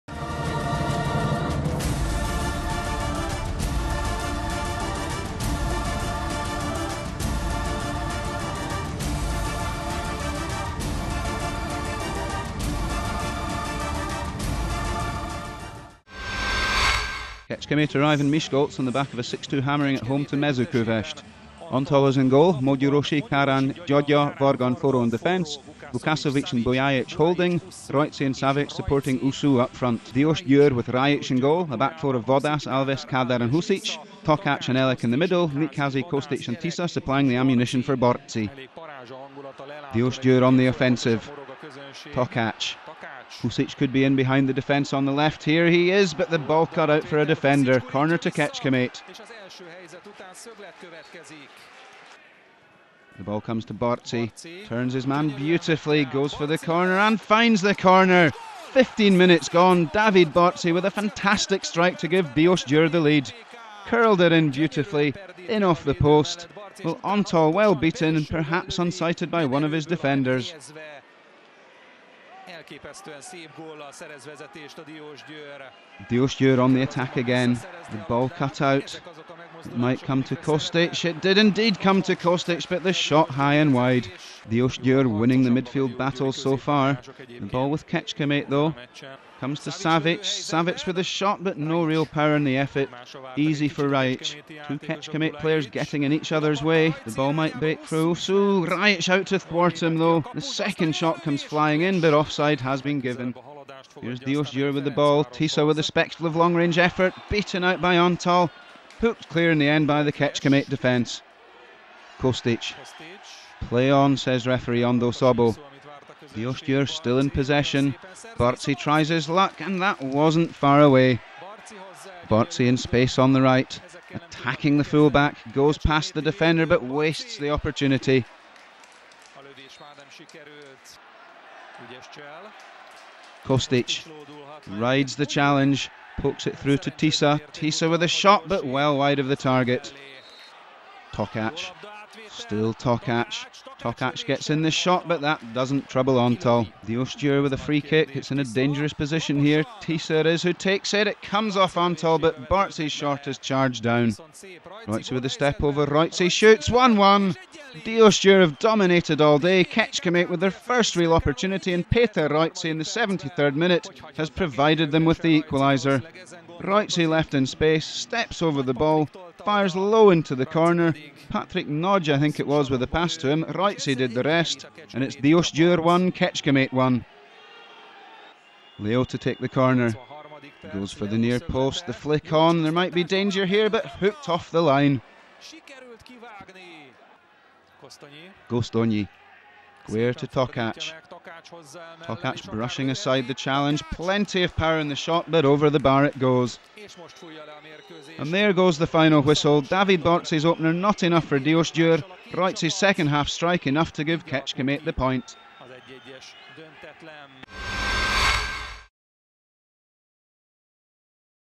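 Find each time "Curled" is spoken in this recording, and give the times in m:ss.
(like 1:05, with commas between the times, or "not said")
1:03.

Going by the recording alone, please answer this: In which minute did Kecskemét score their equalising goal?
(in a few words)
73rd.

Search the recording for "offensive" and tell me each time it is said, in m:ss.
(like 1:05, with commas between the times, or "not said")
0:40.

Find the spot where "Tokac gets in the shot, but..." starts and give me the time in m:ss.
2:23.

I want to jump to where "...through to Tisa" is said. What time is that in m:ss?
2:16.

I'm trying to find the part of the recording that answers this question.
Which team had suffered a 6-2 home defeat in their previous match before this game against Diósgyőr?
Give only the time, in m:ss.
0:20.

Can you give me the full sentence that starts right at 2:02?
Bárczi uh, in space on the right, attacking the fullback, goes past the defender but wastes the opportunity.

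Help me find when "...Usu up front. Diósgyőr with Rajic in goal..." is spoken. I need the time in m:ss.
0:29.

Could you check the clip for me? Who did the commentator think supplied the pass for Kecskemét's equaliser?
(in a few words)
Patrick Nodge.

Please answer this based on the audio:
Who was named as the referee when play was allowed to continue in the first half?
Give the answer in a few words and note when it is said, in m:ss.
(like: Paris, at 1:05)
Ondo Sobo, at 1:54.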